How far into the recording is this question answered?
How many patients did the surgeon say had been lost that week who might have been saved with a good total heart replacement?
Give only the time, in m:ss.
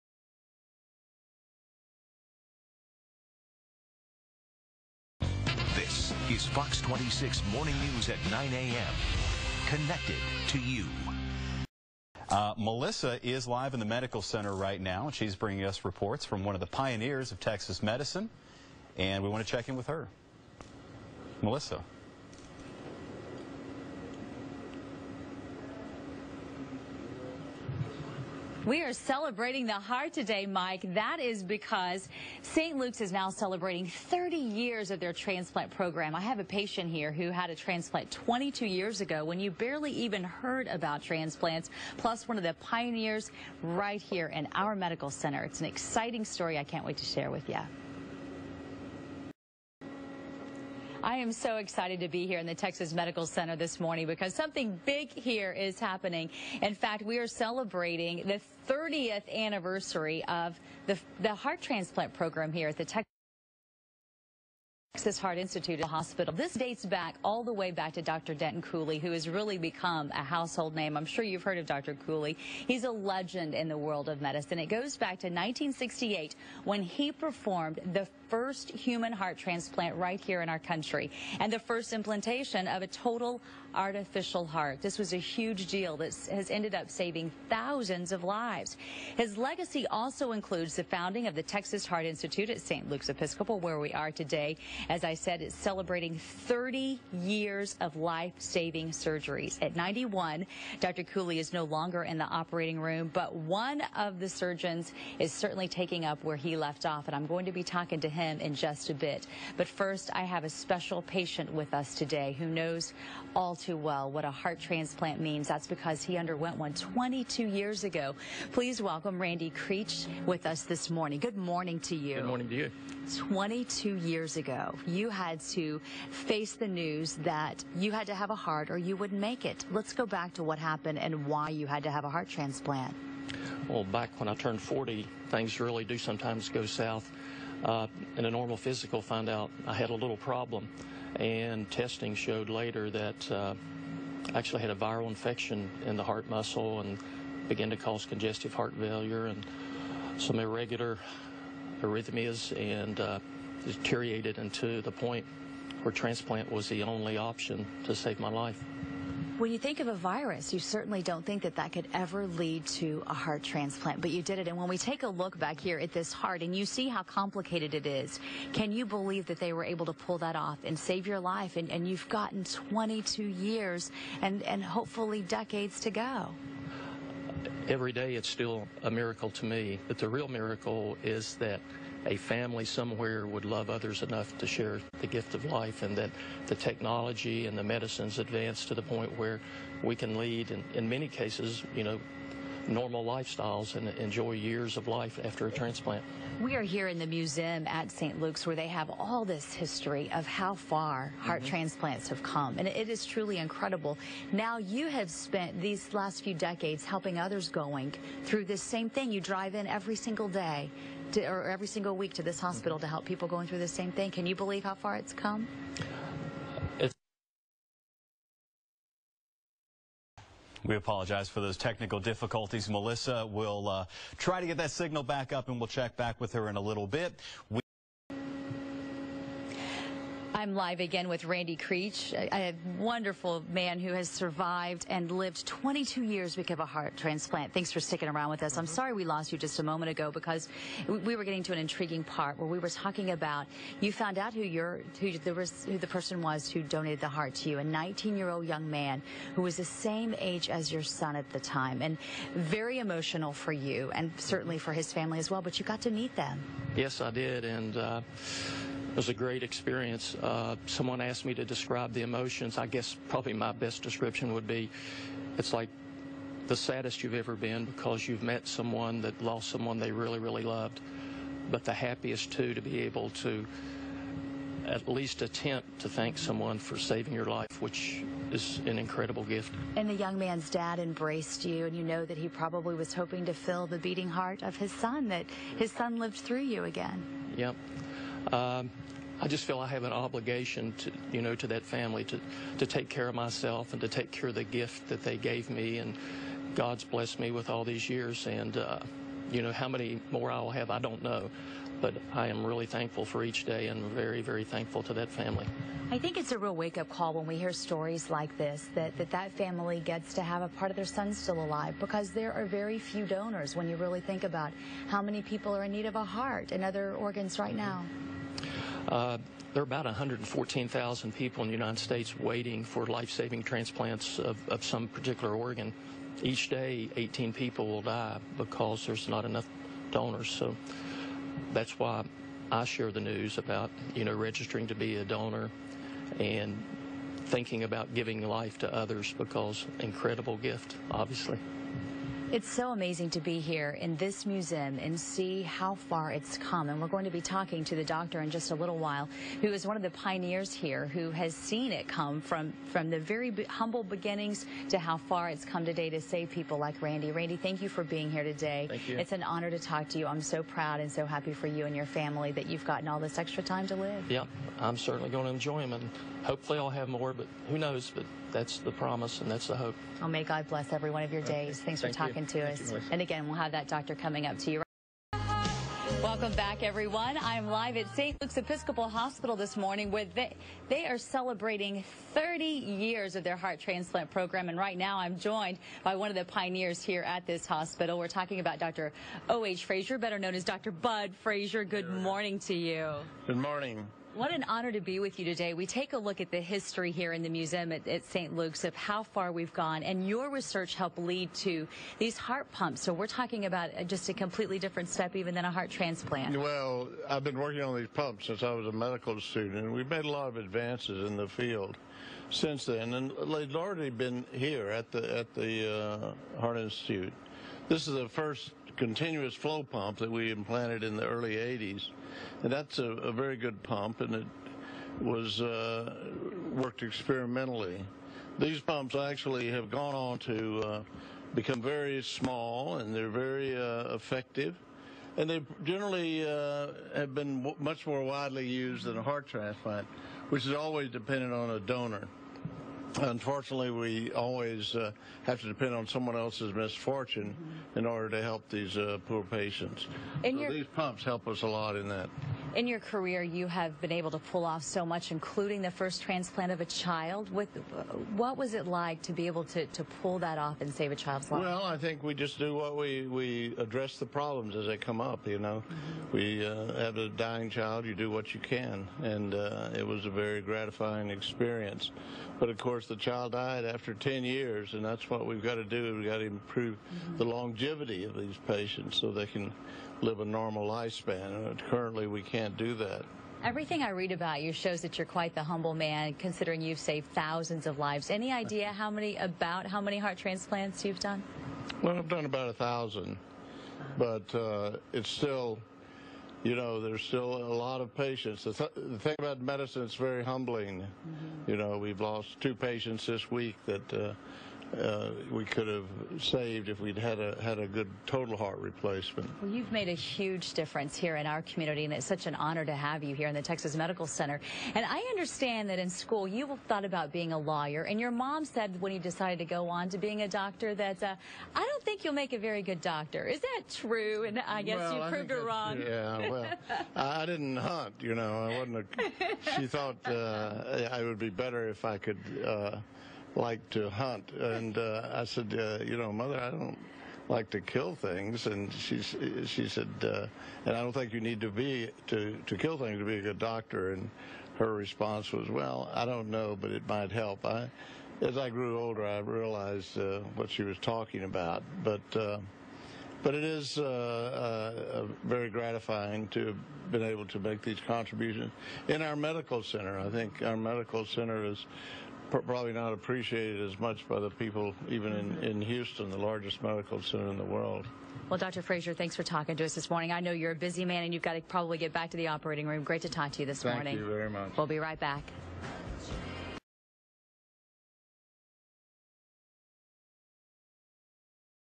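8:22.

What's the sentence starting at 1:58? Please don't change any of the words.
Please welcome Randy Creech with us this morning.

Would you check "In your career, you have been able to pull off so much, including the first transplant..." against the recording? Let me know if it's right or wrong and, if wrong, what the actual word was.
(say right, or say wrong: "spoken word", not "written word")
right.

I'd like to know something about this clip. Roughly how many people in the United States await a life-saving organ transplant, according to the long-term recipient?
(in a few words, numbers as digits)
114,000.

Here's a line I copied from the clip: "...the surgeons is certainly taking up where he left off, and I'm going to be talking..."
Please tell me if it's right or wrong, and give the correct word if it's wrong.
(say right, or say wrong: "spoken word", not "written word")
right.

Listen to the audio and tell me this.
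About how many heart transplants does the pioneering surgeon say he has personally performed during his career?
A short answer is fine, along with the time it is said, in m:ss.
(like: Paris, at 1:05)
About 1,000, at 8:12.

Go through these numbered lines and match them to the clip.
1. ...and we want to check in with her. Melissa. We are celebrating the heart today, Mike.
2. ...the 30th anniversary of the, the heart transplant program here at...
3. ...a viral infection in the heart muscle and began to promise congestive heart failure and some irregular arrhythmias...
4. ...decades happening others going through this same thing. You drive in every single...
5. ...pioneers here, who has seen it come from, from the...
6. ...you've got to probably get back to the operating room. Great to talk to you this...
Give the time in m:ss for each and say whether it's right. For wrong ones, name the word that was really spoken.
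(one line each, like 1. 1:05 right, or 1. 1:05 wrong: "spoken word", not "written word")
1. 0:18 right
2. 0:58 right
3. 2:24 wrong: "cause", not "promise"
4. 3:26 wrong: "helping", not "happening"
5. 5:49 right
6. 9:31 right.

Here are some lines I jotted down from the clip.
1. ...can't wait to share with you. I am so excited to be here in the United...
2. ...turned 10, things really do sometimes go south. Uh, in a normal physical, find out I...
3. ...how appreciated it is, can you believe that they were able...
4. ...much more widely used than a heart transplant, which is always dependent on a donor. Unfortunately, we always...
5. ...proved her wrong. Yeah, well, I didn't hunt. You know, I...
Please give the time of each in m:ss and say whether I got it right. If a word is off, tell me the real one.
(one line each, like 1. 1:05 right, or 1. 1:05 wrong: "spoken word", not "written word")
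1. 0:46 wrong: "Texas", not "United"
2. 2:14 wrong: "40", not "10"
3. 2:46 wrong: "complicated", not "appreciated"
4. 7:17 right
5. 8:45 right.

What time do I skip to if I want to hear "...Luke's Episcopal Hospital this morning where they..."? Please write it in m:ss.
6:18.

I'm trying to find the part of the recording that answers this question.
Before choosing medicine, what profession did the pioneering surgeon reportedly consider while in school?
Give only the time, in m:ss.
8:37.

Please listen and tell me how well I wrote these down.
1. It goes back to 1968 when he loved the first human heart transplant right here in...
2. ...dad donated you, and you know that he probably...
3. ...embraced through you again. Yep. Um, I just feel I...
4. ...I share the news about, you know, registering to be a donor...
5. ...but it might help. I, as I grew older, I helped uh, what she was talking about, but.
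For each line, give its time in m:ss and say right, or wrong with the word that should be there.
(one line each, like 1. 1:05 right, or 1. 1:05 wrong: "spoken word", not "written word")
1. 1:14 wrong: "performed", not "loved"
2. 4:40 wrong: "embraced", not "donated"
3. 4:45 wrong: "lived", not "embraced"
4. 5:32 right
5. 9:06 wrong: "realized", not "helped".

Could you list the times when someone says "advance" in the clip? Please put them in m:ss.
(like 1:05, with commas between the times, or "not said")
3:08, 6:50.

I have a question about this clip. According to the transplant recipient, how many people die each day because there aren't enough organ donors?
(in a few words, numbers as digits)
18.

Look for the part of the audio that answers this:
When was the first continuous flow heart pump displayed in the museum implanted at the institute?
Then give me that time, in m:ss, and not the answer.
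7:01.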